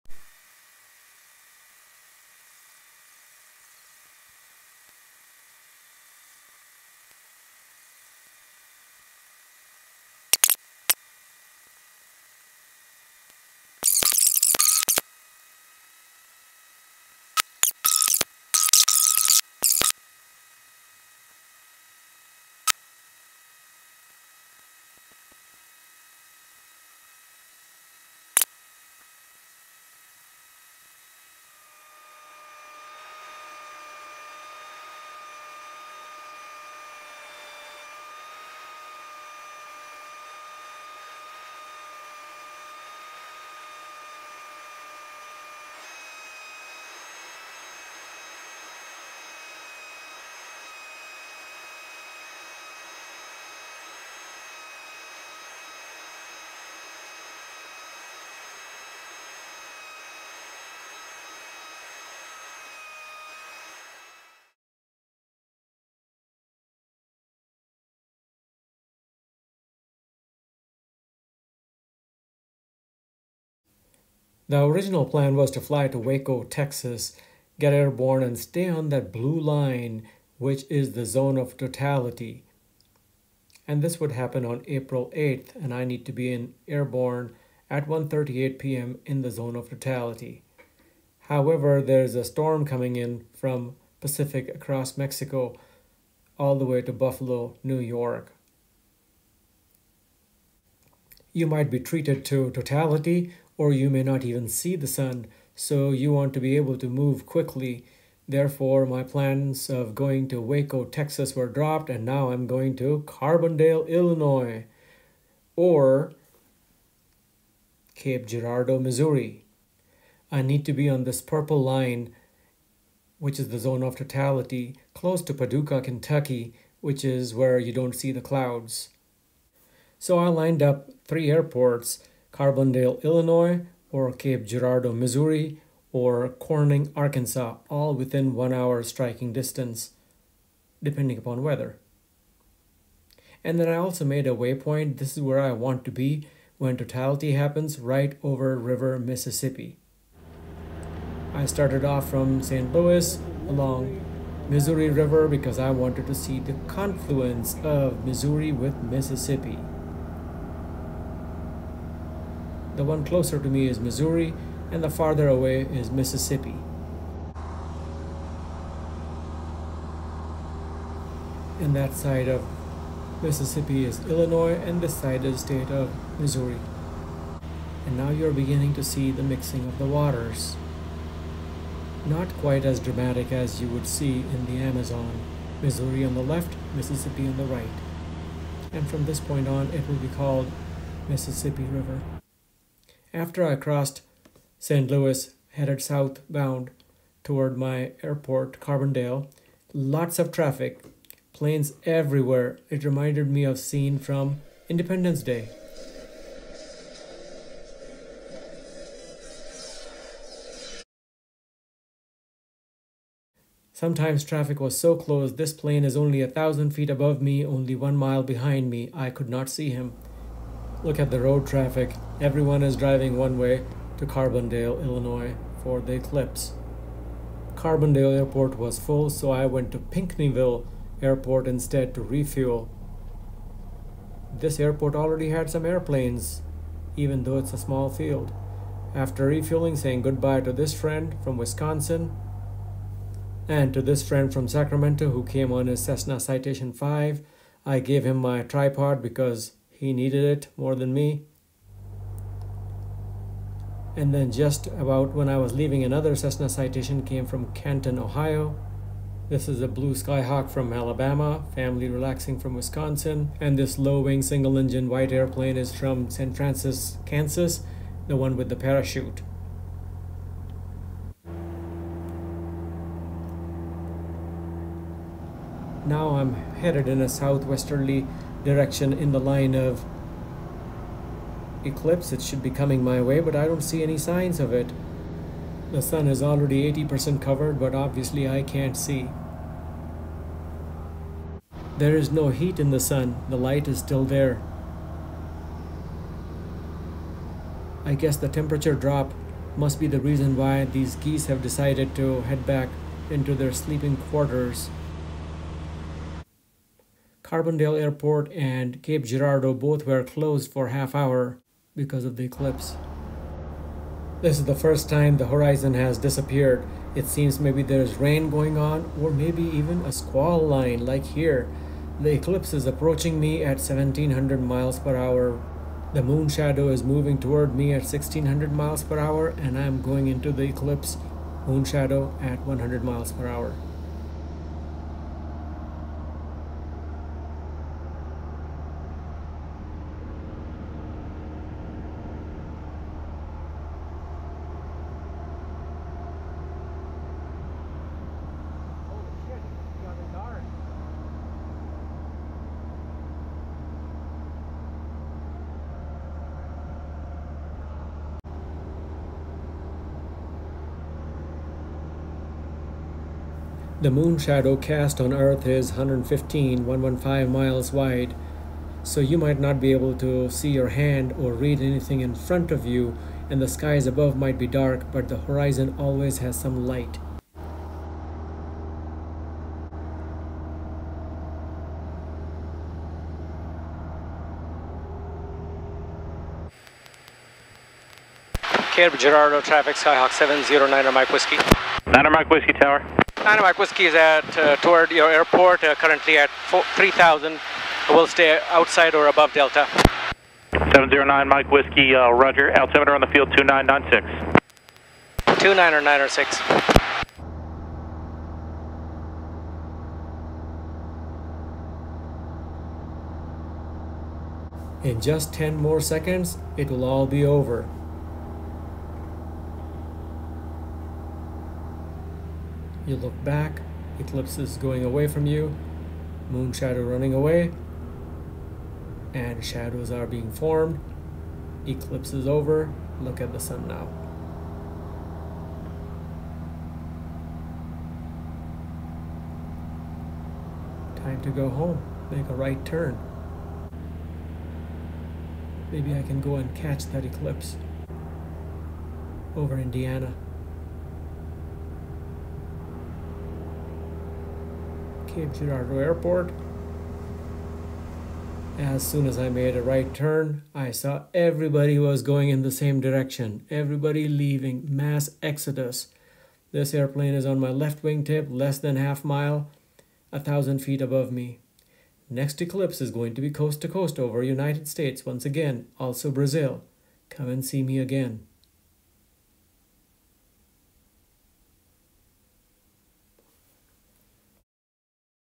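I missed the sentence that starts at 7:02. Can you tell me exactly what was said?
You look back, Eclipse is going away from you, Moon Shadow running away, and shadows are being formed.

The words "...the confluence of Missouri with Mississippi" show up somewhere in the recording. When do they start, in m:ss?
2:36.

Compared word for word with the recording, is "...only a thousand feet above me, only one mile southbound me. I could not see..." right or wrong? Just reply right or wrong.
wrong.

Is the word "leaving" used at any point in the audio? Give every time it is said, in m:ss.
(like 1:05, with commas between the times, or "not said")
4:15, 7:44.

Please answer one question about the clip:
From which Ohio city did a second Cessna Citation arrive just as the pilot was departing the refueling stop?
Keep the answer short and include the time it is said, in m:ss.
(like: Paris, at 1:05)
Canton, at 4:17.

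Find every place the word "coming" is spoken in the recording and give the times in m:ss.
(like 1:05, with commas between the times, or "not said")
1:32, 4:42.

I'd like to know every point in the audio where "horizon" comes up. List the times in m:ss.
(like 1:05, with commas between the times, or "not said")
5:15, 6:15.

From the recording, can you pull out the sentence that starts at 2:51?
And that side of Mississippi is Illinois, and this side is the state of Missouri.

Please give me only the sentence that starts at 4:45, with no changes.
The sun is already 80% covered, but obviously I can't see.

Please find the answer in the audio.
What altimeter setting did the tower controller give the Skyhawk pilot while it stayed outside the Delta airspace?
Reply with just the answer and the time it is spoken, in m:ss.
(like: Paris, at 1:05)
29.96, at 6:43.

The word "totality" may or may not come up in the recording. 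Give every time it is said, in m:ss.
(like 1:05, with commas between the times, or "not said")
1:21, 1:29, 1:42, 2:03, 2:26.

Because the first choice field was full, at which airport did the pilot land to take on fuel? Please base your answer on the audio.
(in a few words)
Pinckneyville.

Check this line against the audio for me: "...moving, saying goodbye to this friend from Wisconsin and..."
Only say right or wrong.
wrong.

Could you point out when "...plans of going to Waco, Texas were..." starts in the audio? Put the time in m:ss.
1:49.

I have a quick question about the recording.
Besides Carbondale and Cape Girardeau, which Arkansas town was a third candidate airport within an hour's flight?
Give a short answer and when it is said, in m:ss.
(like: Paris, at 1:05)
Corning, at 2:16.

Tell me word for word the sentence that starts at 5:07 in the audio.
Carbondale Airport and Cape Girardeau both were closed for half hour because of the eclipse.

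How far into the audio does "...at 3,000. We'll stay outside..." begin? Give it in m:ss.
6:36.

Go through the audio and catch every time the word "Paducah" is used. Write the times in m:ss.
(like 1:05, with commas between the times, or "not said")
2:05.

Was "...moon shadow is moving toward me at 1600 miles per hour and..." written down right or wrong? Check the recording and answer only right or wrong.
right.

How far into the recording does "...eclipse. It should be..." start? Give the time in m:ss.
4:41.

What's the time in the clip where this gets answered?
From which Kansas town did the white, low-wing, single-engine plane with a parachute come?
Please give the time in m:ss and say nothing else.
4:26.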